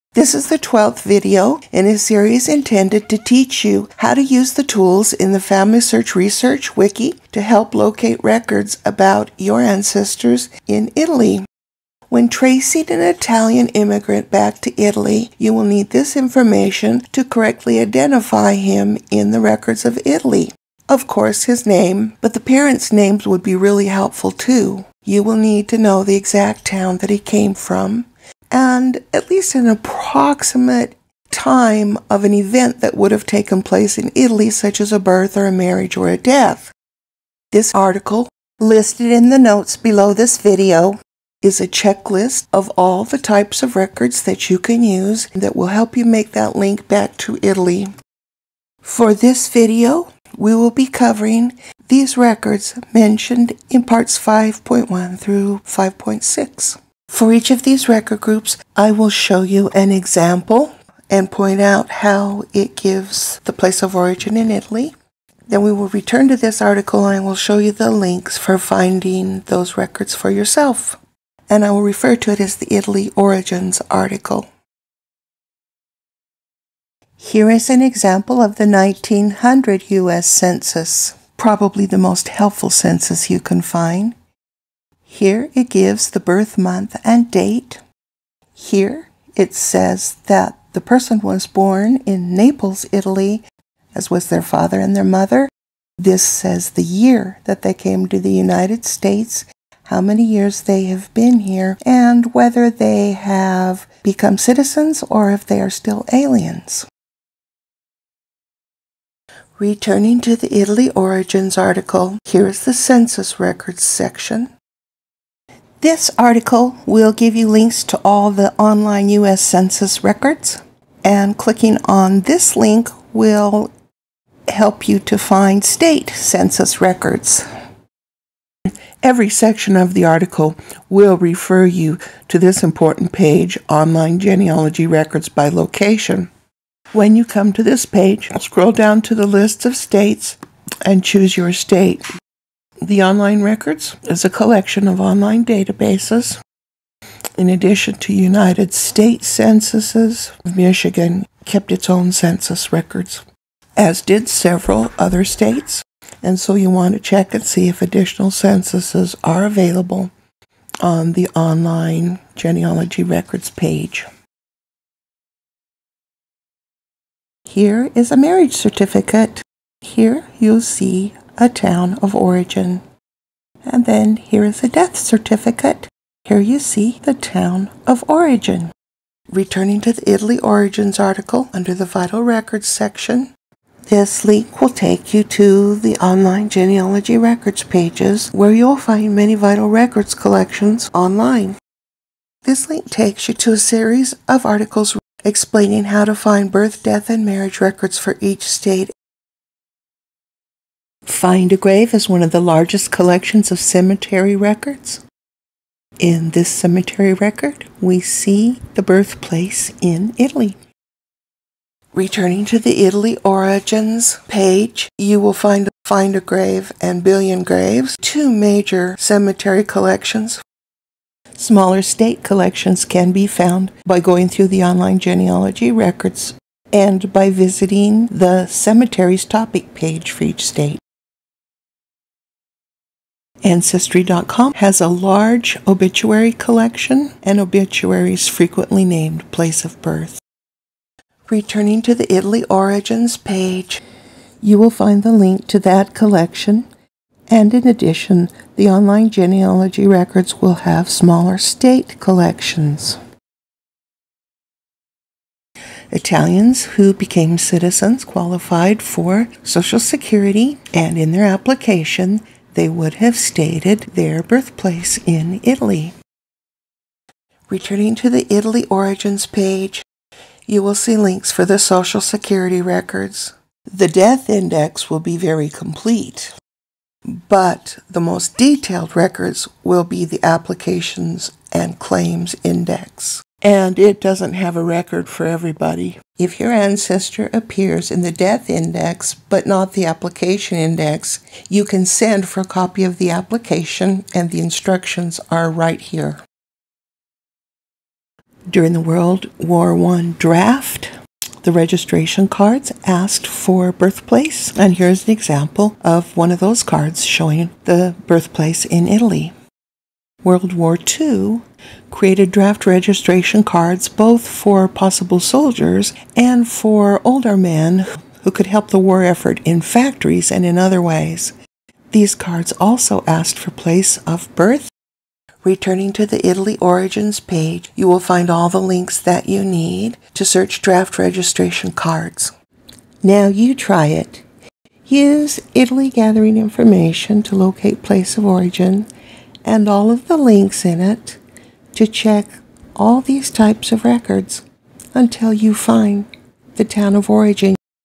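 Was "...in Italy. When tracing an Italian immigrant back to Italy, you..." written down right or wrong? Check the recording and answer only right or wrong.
right.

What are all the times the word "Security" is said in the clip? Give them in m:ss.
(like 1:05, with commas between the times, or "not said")
4:19, 4:32.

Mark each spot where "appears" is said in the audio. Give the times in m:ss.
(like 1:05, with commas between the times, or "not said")
4:47.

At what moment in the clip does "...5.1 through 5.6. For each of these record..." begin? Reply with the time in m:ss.
0:54.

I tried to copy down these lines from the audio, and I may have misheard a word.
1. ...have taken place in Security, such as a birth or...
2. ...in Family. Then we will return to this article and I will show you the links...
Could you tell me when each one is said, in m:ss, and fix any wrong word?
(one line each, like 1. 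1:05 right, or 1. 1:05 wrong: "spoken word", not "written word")
1. 0:33 wrong: "Italy", not "Security"
2. 1:04 wrong: "Italy", not "Family".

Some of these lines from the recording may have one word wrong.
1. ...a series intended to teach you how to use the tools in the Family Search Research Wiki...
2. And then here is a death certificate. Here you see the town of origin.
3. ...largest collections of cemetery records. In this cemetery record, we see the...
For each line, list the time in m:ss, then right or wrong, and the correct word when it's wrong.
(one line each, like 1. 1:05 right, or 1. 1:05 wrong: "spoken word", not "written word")
1. 0:01 right
2. 2:53 right
3. 3:22 right.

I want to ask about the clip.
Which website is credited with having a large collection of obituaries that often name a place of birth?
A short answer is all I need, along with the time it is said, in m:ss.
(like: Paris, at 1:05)
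Ancestry.com, at 3:53.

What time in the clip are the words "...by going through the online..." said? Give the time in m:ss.
3:43.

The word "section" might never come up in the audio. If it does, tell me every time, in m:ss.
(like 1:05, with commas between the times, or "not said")
1:53, 2:09, 3:02.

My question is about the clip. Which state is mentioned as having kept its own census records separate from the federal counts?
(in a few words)
Michigan.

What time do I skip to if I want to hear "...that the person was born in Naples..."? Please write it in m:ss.
1:30.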